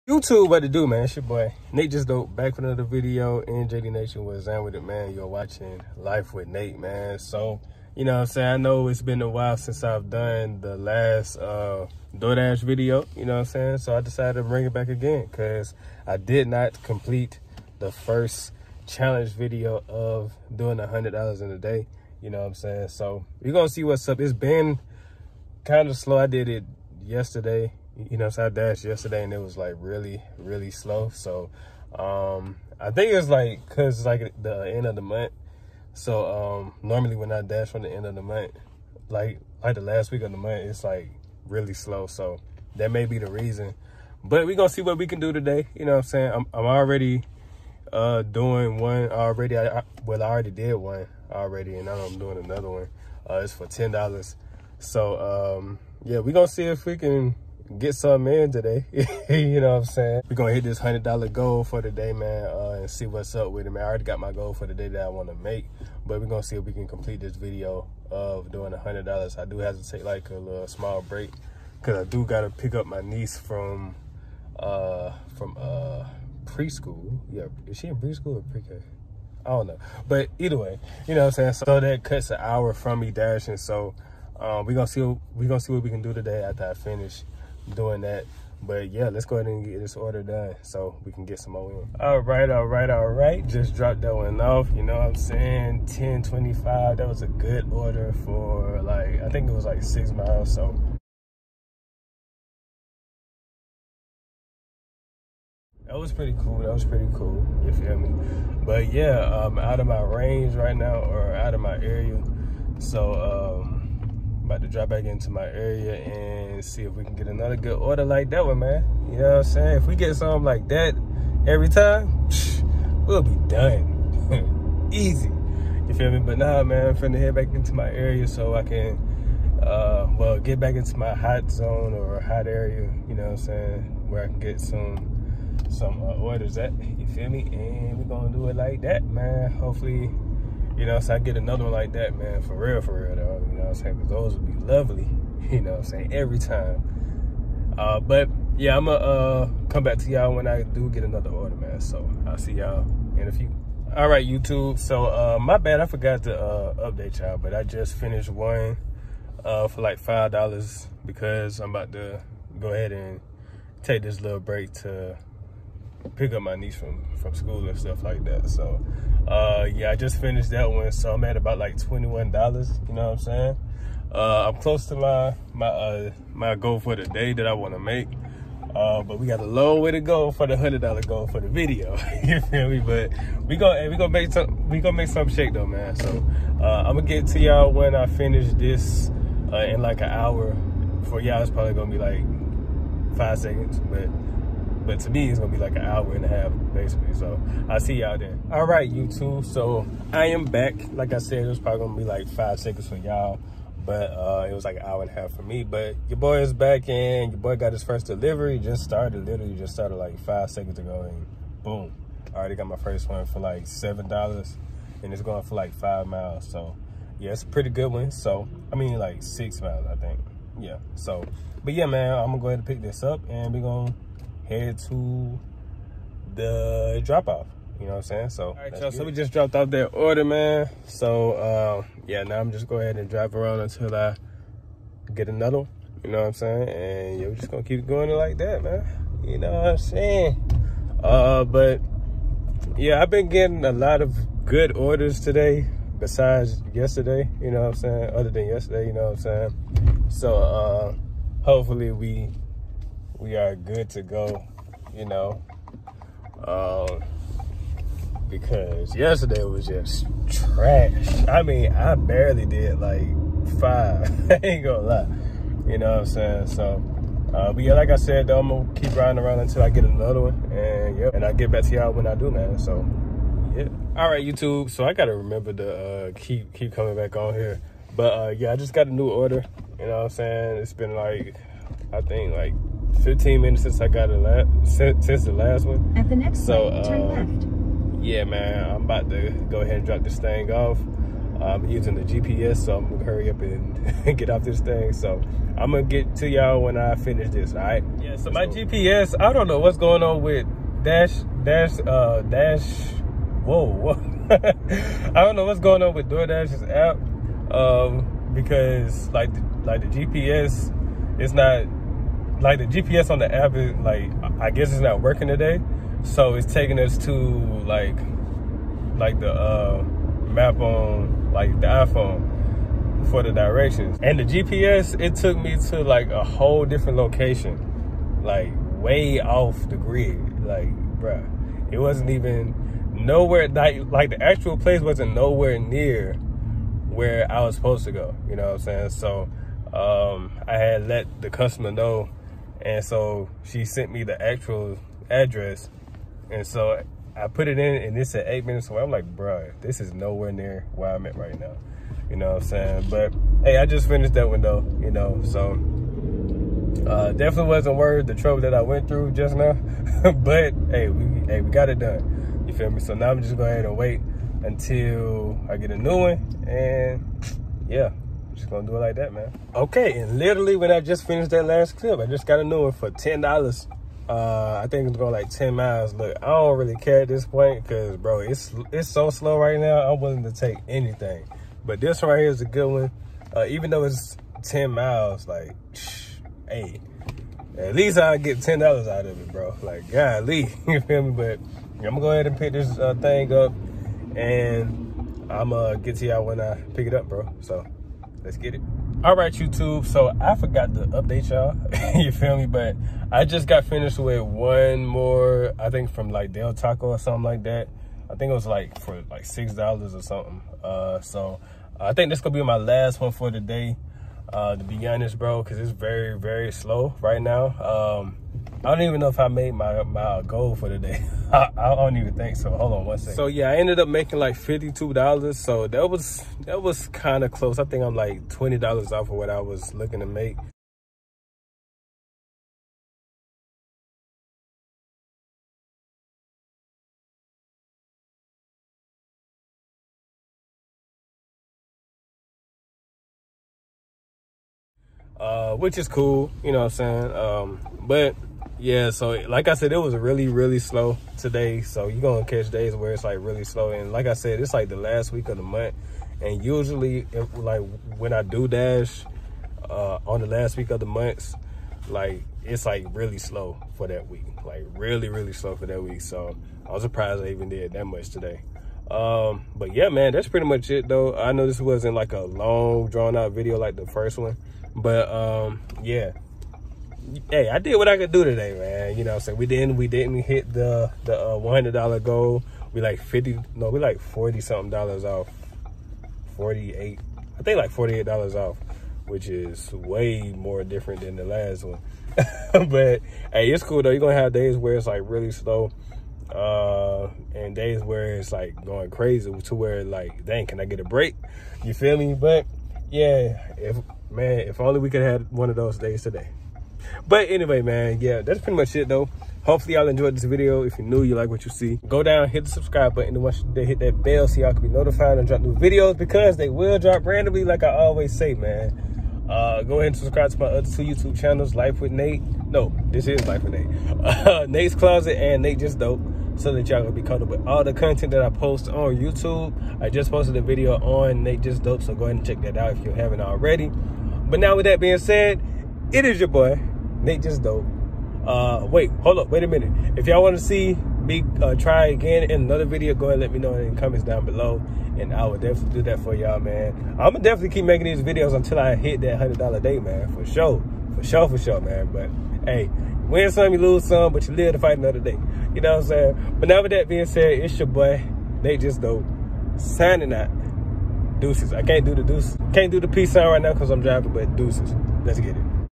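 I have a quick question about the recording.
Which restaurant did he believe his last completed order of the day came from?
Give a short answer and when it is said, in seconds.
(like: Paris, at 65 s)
Del Taco, at 406 s.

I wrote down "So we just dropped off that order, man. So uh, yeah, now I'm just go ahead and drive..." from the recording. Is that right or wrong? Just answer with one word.
right.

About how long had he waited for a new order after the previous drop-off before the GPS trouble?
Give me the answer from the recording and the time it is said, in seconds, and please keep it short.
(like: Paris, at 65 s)
15 minutes, at 283 s.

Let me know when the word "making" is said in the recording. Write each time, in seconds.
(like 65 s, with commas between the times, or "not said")
423 s, 547 s.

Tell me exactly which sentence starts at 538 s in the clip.
Uh, wait, hold up, wait a minute.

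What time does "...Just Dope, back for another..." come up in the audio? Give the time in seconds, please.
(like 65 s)
1 s.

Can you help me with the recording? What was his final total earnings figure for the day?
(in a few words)
$52.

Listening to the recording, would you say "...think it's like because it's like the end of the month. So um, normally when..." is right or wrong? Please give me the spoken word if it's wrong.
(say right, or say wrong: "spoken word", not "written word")
right.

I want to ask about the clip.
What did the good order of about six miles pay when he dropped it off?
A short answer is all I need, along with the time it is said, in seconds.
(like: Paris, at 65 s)
$10.25, at 95 s.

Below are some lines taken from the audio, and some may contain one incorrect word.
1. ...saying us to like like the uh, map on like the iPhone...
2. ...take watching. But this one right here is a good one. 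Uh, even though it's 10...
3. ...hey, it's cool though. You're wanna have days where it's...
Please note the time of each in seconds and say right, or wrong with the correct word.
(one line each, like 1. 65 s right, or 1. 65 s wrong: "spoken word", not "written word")
1. 316 s wrong: "taking", not "saying"
2. 380 s wrong: "anything", not "watching"
3. 493 s wrong: "gonna", not "wanna".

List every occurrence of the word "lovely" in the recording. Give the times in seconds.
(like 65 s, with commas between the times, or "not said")
144 s.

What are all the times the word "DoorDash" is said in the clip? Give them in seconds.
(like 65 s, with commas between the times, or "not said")
12 s, 306 s.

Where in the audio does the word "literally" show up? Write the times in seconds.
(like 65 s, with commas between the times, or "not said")
209 s, 370 s.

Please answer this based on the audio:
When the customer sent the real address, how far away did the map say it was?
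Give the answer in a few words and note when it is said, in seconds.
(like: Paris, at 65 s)
8 minutes, at 348 s.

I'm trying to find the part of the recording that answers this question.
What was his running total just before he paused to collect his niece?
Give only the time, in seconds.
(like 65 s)
171 s.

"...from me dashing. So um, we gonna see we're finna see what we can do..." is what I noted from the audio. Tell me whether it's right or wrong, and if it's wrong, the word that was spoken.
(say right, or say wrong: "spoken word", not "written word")
wrong: "gonna", not "finna".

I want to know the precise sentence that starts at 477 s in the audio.
Hey, I did what I could do today, man.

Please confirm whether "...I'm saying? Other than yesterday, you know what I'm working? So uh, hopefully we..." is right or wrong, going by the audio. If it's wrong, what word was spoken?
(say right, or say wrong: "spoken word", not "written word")
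wrong: "saying", not "working".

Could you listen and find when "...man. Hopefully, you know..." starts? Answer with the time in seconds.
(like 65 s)
139 s.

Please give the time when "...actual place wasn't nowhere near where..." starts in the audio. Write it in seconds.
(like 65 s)
334 s.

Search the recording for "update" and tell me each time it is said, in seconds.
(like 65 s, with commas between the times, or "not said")
156 s, 400 s.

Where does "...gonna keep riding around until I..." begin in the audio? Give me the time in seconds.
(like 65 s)
268 s.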